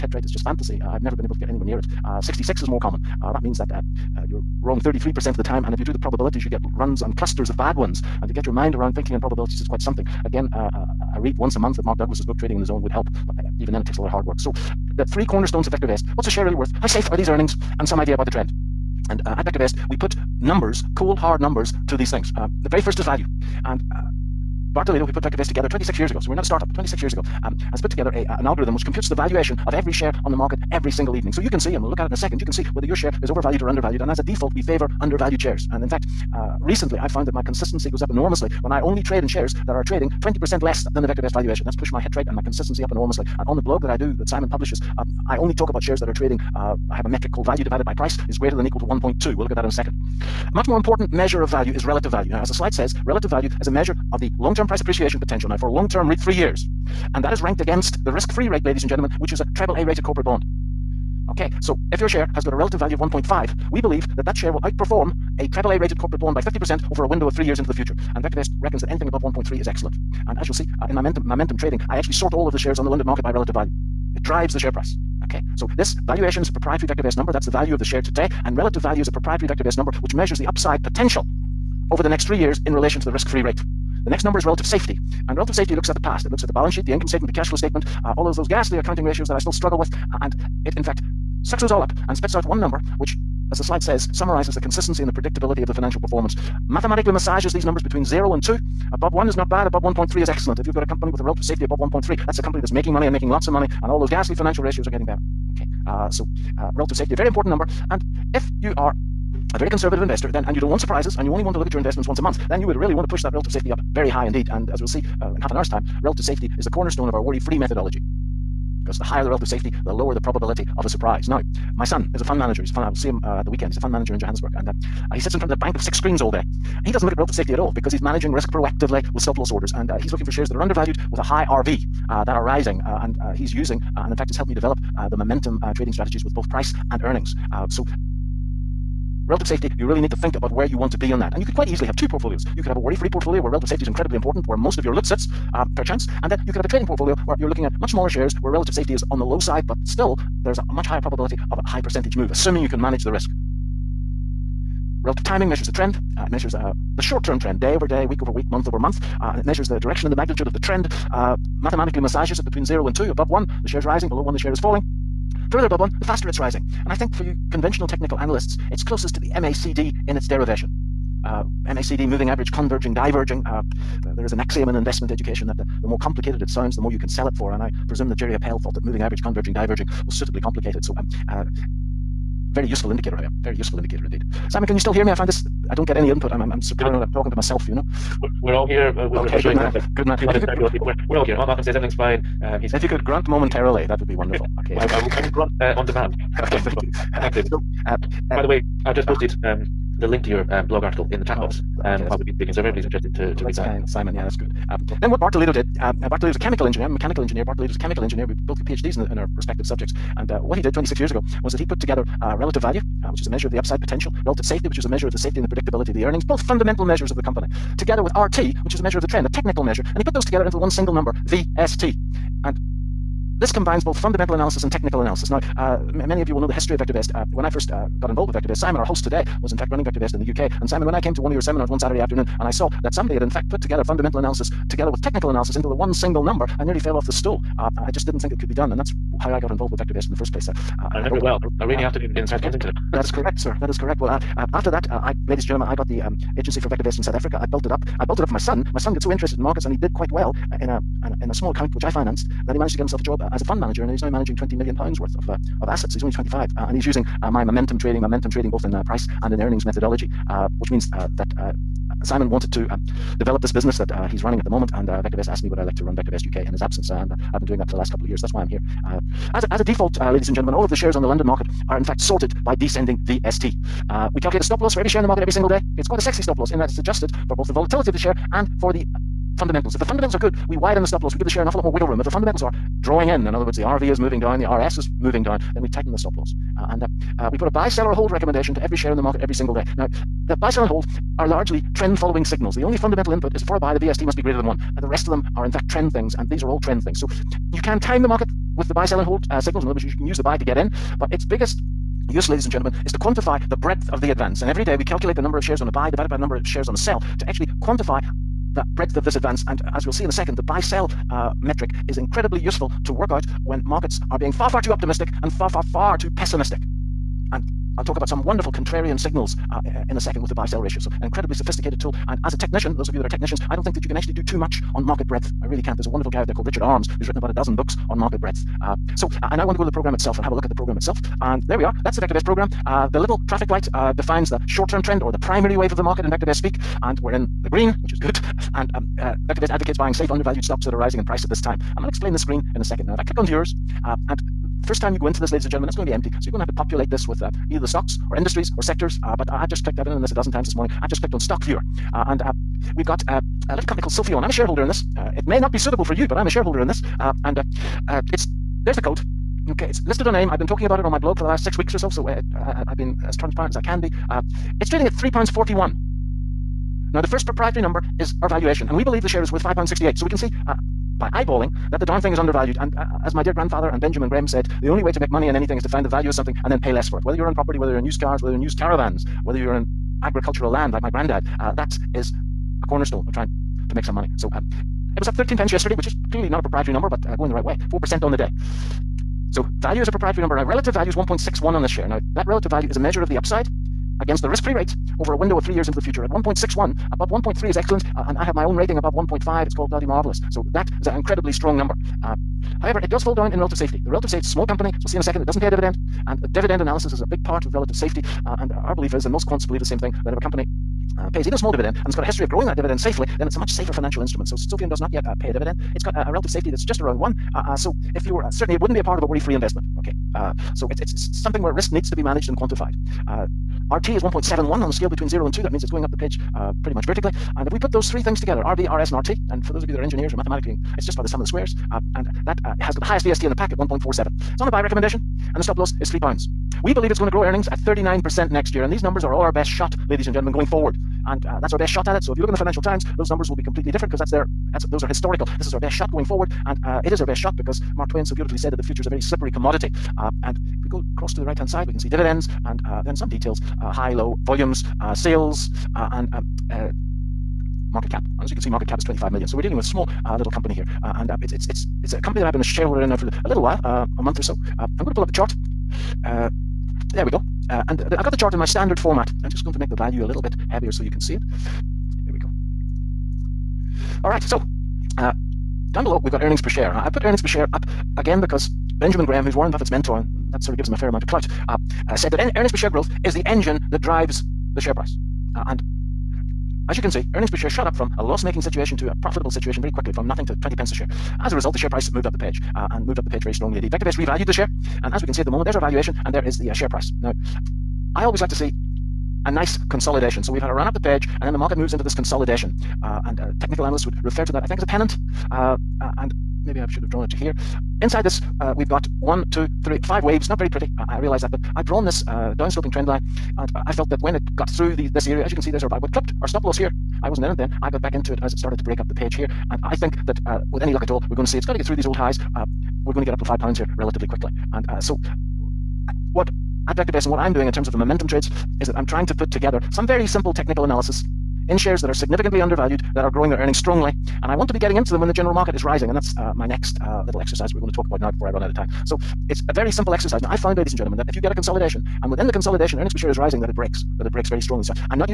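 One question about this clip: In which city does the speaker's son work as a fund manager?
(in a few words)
Johannesburg.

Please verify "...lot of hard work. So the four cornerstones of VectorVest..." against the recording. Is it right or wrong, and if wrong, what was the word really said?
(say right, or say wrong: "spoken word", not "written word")
wrong: "three", not "four".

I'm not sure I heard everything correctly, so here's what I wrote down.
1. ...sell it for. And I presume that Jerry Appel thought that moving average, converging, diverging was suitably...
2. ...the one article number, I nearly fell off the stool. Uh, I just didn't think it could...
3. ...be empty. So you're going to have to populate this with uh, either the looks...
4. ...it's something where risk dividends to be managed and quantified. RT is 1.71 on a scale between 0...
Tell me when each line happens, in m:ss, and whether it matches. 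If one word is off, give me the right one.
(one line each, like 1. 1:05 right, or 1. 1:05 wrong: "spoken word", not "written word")
1. 2:57 right
2. 3:55 wrong: "single", not "article"
3. 5:45 wrong: "stocks", not "looks"
4. 7:00 wrong: "needs", not "dividends".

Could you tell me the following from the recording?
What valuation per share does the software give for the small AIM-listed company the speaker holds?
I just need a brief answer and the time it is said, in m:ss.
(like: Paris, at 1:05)
£5.68, at 6:09.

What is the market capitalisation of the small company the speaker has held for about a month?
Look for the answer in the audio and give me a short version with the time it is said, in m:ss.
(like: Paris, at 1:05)
25 million, at 7:38.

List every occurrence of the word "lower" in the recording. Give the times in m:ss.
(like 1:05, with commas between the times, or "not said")
1:59.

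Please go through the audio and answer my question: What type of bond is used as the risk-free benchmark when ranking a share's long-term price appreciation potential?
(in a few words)
AAA-rated corporate bond.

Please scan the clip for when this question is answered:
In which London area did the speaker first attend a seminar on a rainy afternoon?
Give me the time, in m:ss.
4:02.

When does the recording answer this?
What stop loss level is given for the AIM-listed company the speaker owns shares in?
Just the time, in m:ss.
7:15.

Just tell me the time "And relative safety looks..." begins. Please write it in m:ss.
1:25.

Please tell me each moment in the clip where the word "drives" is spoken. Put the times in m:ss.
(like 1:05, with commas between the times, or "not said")
1:14, 8:03.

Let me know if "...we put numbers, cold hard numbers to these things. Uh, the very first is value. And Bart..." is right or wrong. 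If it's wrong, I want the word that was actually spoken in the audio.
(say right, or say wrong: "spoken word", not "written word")
right.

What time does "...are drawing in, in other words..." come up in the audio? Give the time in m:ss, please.
4:42.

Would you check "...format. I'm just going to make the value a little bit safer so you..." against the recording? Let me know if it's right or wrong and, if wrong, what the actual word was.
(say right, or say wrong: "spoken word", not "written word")
wrong: "heavier", not "safer".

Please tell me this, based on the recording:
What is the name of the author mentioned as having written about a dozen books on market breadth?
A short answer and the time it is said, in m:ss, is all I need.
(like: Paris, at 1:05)
Richard Arms, at 5:26.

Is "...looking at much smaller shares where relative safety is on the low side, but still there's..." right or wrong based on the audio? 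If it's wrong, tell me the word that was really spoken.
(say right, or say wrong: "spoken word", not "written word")
right.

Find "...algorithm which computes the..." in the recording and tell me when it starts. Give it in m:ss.
0:28.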